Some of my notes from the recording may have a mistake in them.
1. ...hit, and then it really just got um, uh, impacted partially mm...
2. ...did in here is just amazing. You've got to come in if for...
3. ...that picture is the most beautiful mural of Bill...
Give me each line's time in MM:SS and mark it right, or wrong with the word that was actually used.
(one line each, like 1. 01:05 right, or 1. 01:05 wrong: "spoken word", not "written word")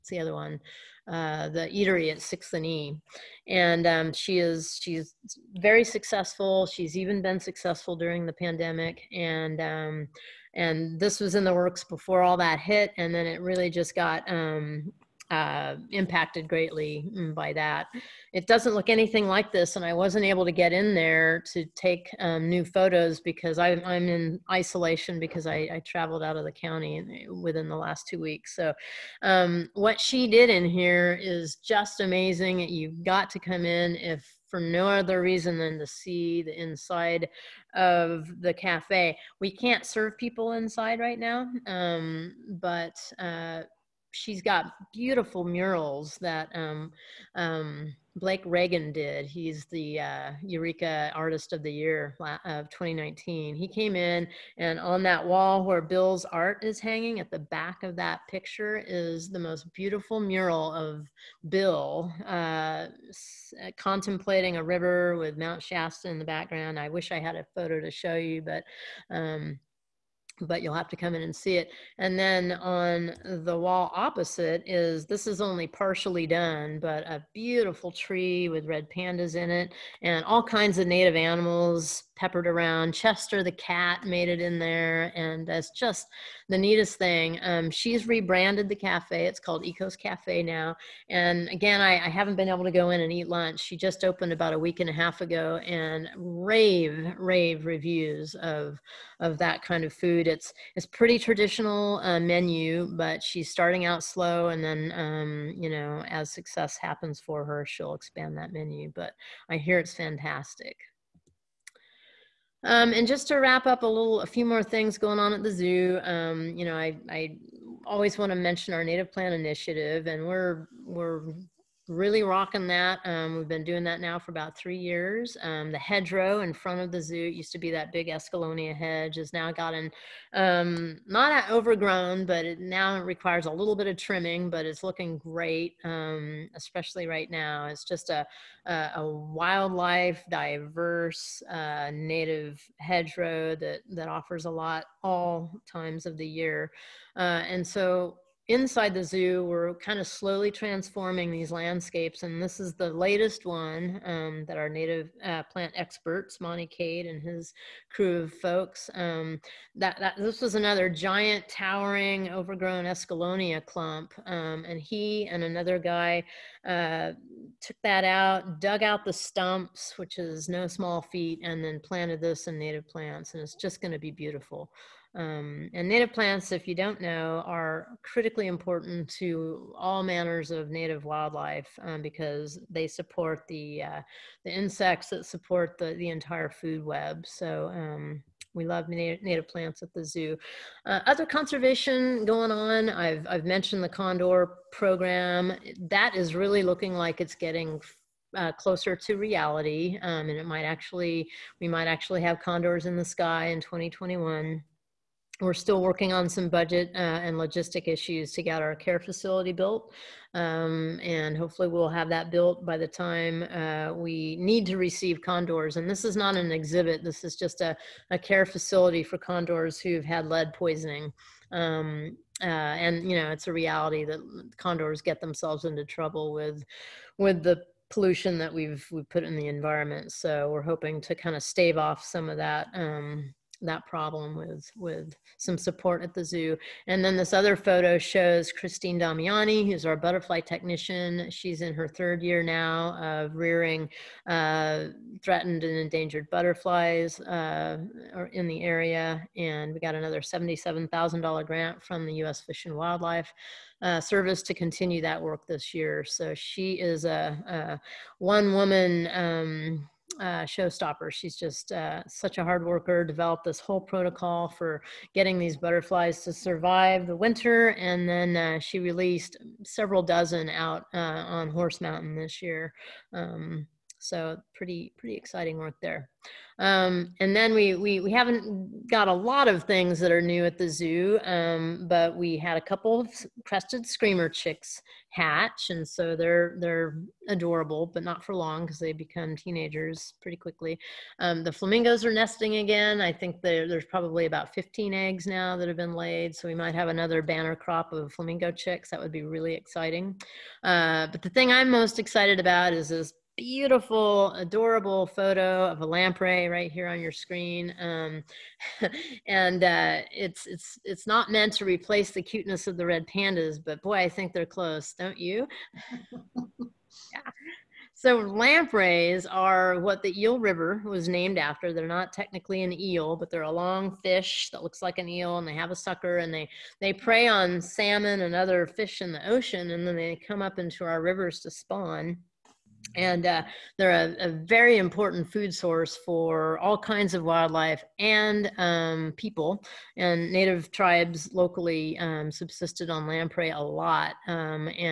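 1. 00:12 wrong: "greatly", not "partially"
2. 00:30 right
3. 00:57 right.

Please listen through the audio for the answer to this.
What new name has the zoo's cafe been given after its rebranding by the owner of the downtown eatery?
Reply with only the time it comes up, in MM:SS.
01:29.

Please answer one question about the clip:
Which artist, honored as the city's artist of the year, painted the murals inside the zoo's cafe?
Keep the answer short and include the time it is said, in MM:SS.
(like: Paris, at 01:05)
Blake Reagan, at 00:48.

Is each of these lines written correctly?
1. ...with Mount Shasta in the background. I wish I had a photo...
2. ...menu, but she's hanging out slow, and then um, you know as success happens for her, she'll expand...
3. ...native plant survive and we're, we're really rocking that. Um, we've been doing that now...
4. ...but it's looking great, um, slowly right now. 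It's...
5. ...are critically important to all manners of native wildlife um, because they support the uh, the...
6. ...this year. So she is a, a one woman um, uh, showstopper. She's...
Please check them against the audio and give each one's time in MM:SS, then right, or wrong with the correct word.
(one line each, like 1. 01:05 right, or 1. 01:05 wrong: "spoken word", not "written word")
1. 01:05 right
2. 01:42 wrong: "starting", not "hanging"
3. 01:58 wrong: "initiative", not "survive"
4. 02:14 wrong: "especially", not "slowly"
5. 02:57 right
6. 04:15 right.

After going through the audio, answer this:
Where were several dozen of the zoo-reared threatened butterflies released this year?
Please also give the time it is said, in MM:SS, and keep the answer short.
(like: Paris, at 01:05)
Horse Mountain, at 04:31.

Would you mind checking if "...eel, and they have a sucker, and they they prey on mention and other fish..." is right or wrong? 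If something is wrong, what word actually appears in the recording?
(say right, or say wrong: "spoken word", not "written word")
wrong: "salmon", not "mention".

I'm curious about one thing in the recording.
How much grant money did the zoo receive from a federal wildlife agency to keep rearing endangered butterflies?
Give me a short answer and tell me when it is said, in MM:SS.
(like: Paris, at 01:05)
$77,000, at 04:10.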